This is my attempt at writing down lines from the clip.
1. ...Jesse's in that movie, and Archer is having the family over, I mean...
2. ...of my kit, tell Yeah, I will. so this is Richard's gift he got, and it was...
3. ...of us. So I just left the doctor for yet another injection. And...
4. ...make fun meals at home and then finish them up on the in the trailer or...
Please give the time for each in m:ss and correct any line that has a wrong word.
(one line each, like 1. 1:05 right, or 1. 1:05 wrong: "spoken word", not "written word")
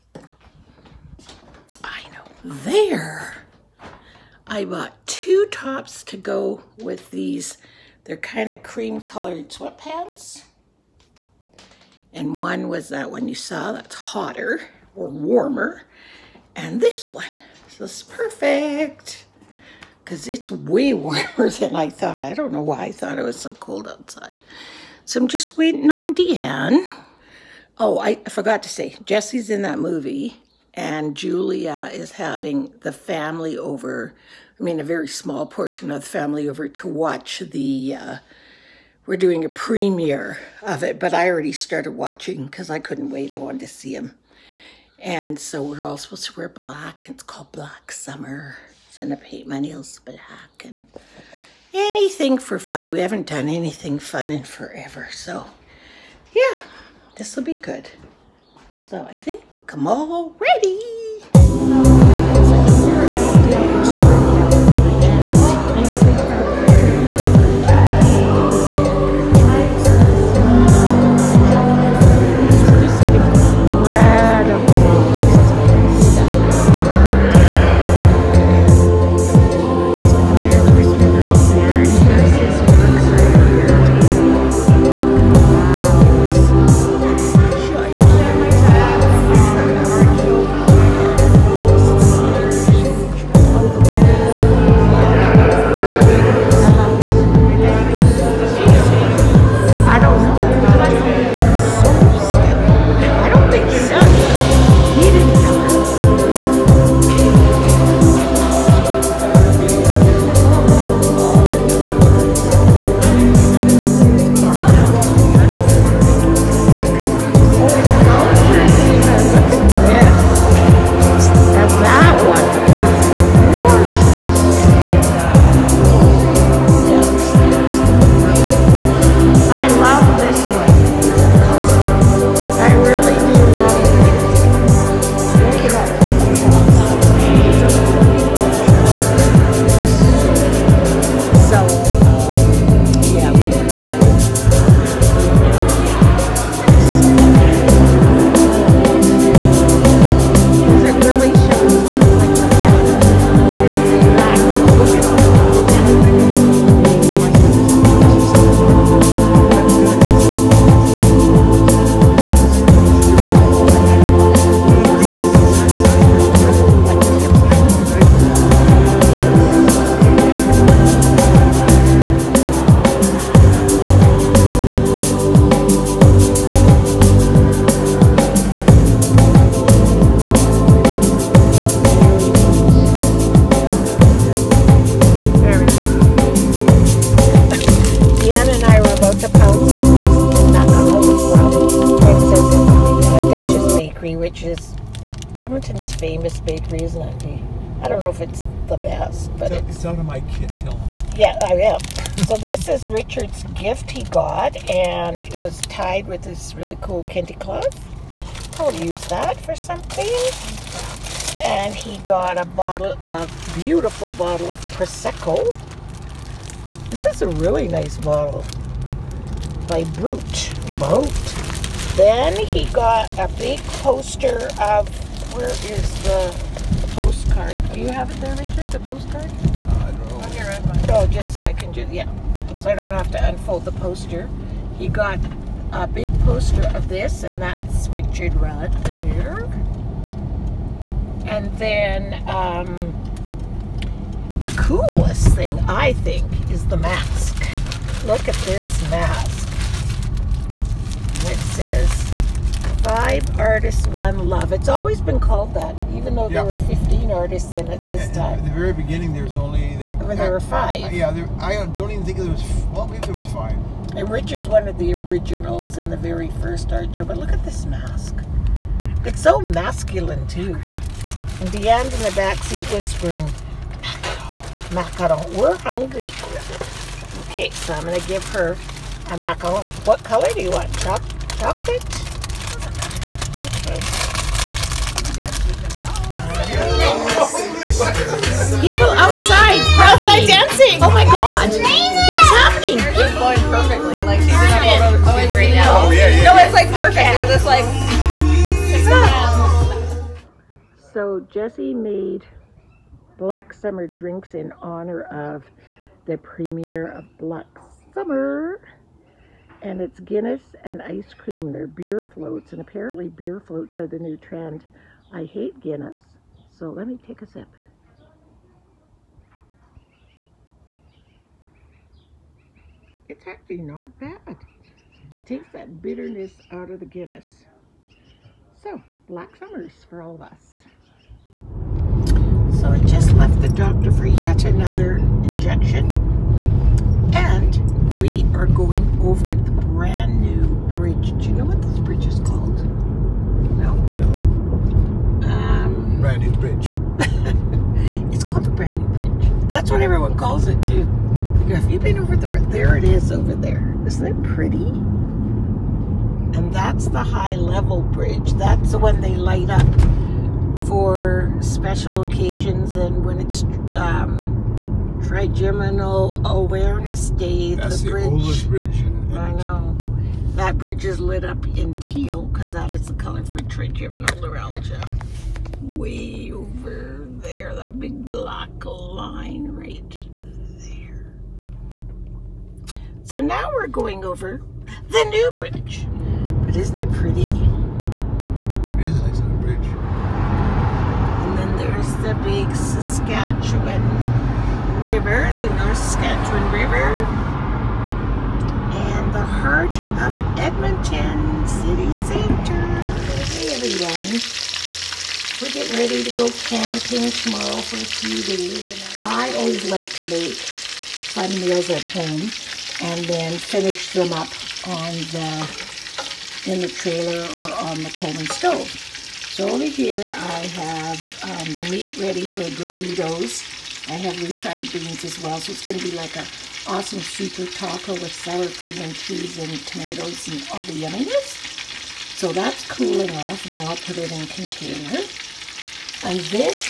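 1. 0:29 wrong: "Julia", not "Archer"
2. 3:19 right
3. 5:30 right
4. 6:50 right.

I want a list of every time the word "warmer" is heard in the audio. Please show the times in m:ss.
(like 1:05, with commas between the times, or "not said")
0:15, 0:20.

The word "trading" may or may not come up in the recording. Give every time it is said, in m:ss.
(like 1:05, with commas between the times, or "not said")
not said.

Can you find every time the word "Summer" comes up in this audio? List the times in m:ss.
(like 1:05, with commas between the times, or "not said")
0:47, 5:03, 5:07, 5:29.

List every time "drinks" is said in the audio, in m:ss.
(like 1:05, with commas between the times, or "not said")
5:03.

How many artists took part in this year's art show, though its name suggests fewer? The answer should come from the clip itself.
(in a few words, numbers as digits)
15.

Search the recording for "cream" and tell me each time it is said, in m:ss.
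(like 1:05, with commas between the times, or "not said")
0:08, 5:11, 7:08.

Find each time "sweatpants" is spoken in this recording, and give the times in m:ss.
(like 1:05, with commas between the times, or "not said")
0:09.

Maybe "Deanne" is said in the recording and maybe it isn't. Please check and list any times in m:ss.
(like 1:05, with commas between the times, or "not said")
0:26, 4:31.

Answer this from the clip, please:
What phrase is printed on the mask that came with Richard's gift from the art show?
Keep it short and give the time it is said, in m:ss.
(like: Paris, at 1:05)
Five Artists, One Love, at 4:12.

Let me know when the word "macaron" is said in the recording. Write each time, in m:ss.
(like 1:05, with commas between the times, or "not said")
4:34, 4:39.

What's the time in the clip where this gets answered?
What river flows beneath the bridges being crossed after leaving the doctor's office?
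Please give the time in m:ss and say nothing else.
6:35.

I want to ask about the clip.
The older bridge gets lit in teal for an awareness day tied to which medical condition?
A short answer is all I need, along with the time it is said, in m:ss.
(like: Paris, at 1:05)
Trigeminal neuralgia, at 6:13.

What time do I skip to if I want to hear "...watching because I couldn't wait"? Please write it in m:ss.
0:41.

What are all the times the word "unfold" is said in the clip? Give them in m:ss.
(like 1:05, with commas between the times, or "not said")
3:53.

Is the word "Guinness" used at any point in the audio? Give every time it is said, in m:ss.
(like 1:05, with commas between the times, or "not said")
5:09, 5:15, 5:26.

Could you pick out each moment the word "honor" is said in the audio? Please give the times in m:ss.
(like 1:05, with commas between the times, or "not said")
5:04.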